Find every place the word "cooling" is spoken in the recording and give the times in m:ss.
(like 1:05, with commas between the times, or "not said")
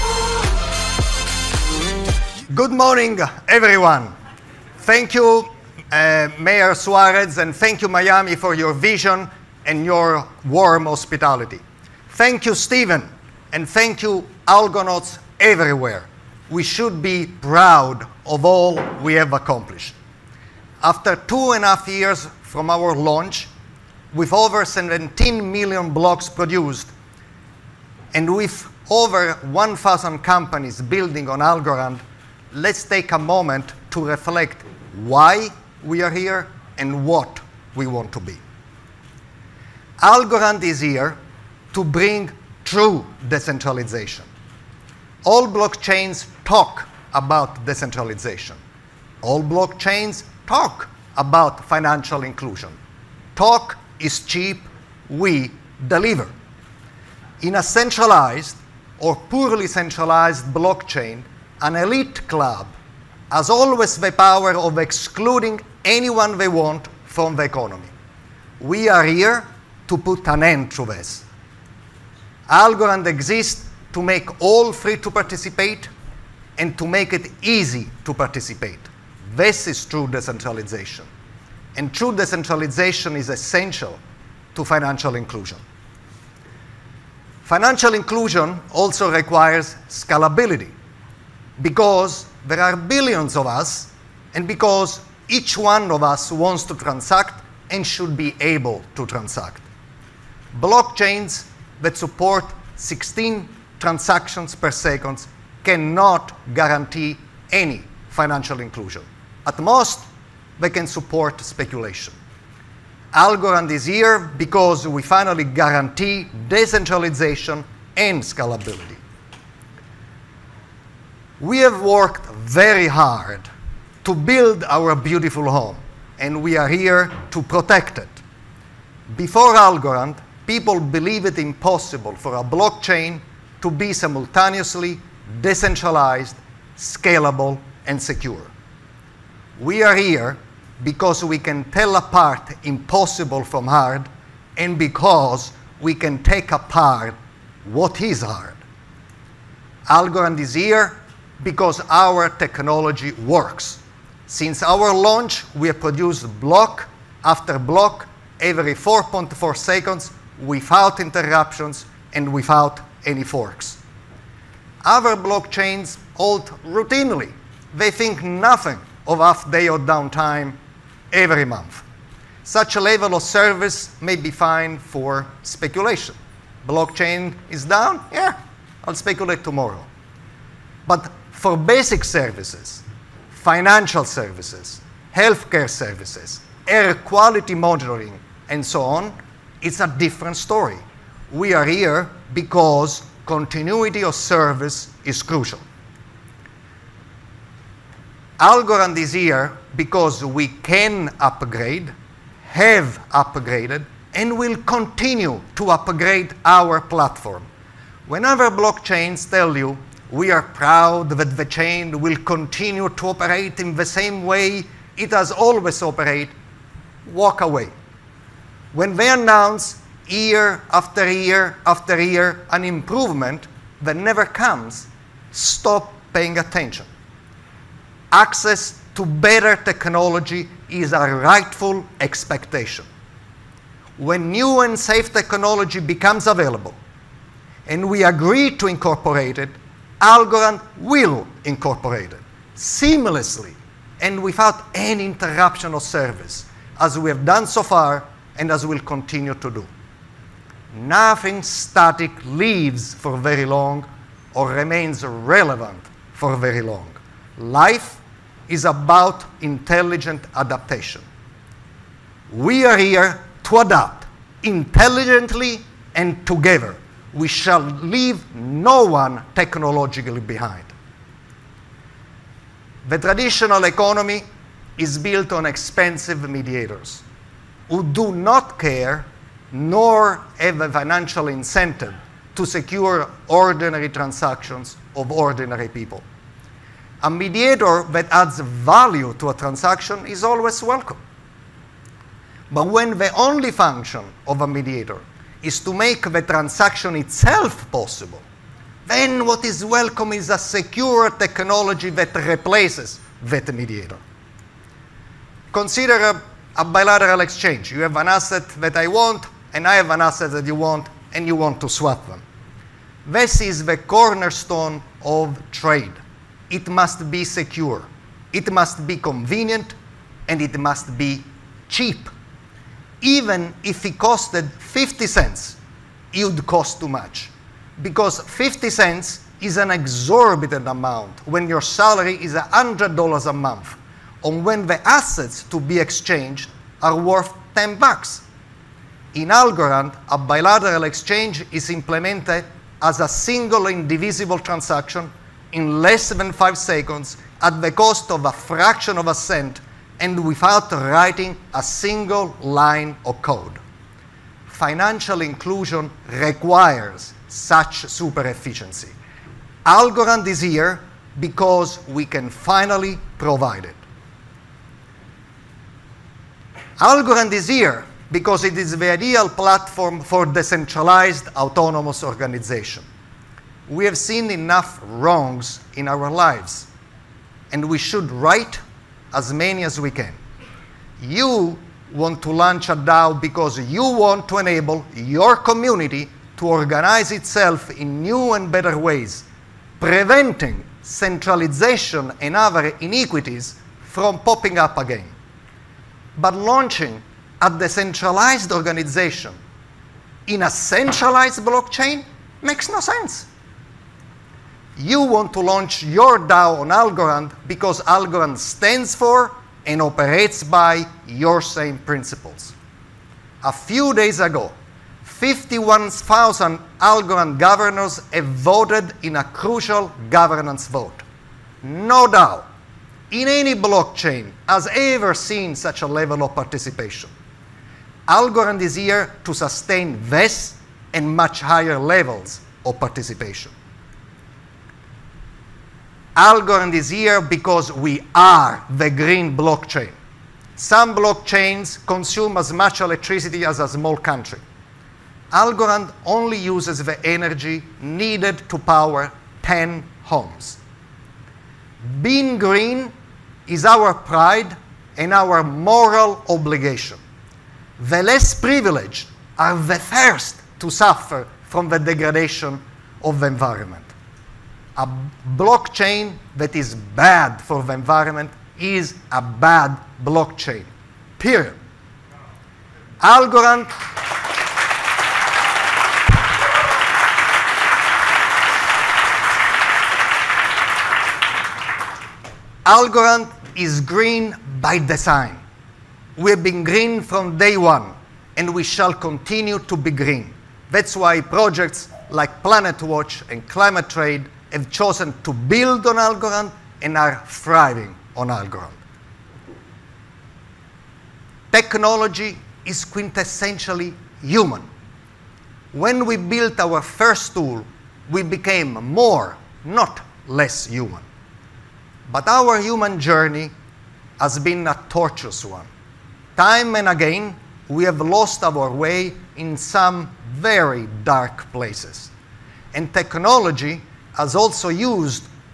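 not said.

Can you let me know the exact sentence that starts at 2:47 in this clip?
They think nothing of off day or downtime every month.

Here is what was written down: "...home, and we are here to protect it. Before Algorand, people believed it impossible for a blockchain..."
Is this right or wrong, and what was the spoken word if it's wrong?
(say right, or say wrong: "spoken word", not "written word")
right.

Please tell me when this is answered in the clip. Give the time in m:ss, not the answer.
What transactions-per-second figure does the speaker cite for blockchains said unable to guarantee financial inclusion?
1:42.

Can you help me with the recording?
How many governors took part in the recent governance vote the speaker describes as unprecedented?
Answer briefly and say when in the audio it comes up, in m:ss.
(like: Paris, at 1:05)
51,000, at 6:55.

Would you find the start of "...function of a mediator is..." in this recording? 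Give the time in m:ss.
4:53.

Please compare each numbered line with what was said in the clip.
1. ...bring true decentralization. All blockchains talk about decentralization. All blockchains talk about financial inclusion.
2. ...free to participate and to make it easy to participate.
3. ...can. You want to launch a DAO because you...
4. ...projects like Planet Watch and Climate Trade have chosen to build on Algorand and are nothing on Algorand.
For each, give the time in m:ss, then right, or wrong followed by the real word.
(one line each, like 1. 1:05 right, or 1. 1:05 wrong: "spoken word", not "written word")
1. 0:41 right
2. 1:14 right
3. 6:19 right
4. 8:11 wrong: "thriving", not "nothing".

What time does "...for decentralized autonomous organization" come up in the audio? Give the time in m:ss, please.
6:09.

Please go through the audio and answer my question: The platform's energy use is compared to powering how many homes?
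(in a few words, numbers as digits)
10 homes.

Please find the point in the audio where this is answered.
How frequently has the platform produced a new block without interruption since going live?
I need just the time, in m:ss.
2:38.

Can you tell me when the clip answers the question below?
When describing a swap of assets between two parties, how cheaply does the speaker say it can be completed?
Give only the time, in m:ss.
5:48.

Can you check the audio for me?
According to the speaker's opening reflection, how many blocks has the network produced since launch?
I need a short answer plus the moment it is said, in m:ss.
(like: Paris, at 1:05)
over 17 million, at 0:24.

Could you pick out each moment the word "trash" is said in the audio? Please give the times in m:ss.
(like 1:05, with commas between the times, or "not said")
not said.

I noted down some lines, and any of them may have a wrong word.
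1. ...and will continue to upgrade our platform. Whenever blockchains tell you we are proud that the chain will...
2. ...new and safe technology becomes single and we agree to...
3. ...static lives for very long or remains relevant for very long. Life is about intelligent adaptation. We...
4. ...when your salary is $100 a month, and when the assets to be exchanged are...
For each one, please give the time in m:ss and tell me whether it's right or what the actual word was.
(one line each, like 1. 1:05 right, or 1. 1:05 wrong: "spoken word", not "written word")
1. 3:24 right
2. 3:54 wrong: "available", not "single"
3. 4:11 right
4. 5:31 right.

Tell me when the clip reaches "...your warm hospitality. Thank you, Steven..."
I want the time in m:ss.
0:09.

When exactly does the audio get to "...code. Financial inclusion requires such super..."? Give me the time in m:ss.
5:53.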